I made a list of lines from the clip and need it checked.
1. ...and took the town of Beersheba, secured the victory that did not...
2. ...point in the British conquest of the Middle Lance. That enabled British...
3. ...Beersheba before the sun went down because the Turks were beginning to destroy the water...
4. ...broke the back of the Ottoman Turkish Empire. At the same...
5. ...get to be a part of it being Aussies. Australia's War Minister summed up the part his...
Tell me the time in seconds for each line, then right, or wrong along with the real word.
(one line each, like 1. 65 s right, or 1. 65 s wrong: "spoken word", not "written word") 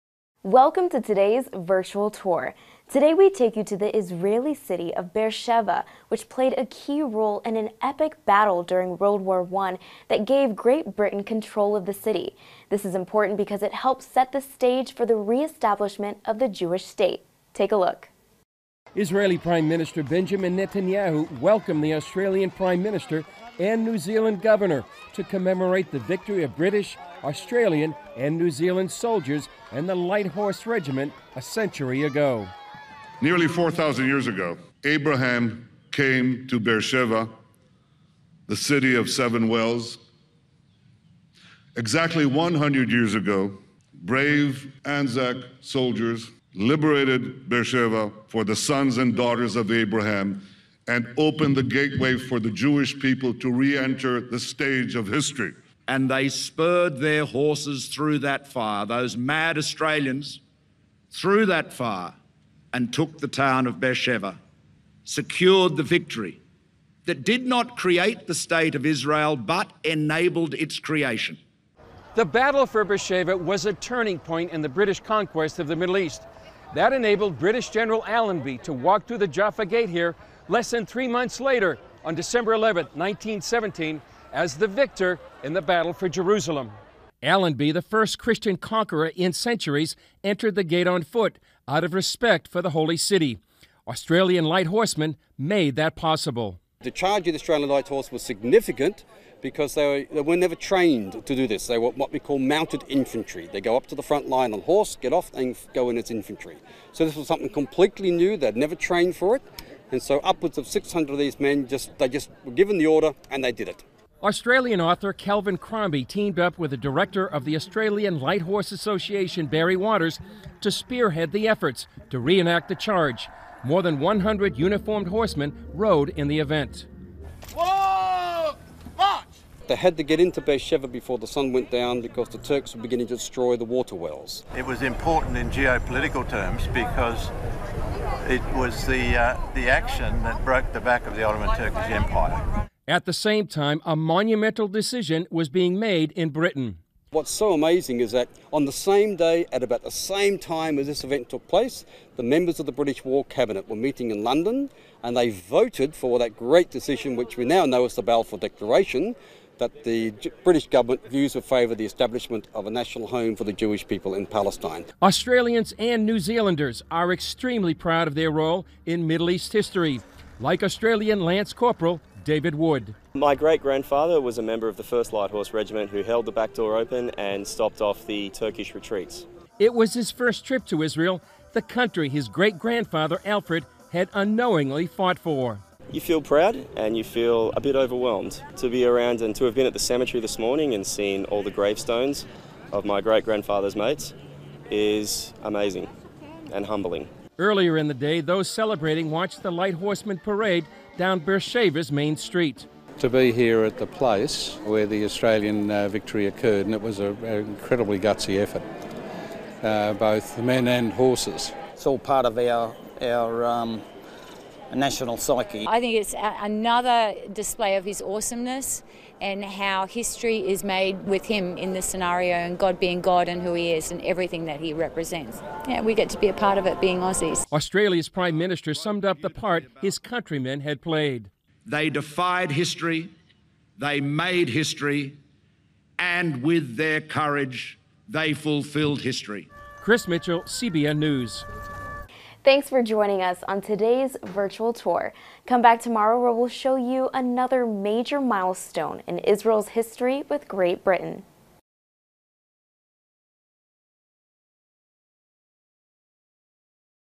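1. 62 s right
2. 74 s wrong: "East", not "Lance"
3. 130 s right
4. 140 s right
5. 225 s wrong: "Prime", not "War".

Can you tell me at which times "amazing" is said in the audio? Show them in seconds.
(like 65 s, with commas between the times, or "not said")
147 s, 195 s.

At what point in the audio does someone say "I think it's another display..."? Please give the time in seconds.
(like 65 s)
215 s.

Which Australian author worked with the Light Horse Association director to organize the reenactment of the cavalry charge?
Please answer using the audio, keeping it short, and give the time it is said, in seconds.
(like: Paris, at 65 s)
Kelvin Crombie, at 115 s.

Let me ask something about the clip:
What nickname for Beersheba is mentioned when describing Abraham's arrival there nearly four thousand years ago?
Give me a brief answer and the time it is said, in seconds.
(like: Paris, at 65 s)
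city of seven wells, at 38 s.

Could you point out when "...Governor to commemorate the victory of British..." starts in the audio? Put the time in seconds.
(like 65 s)
24 s.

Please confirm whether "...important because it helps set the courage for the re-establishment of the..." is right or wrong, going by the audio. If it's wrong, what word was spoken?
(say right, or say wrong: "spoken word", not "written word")
wrong: "stage", not "courage".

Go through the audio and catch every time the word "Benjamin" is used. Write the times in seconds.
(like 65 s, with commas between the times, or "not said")
20 s.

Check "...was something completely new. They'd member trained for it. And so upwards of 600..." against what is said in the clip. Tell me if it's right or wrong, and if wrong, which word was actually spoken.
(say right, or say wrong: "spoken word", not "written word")
wrong: "never", not "member".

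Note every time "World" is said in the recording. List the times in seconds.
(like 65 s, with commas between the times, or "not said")
8 s.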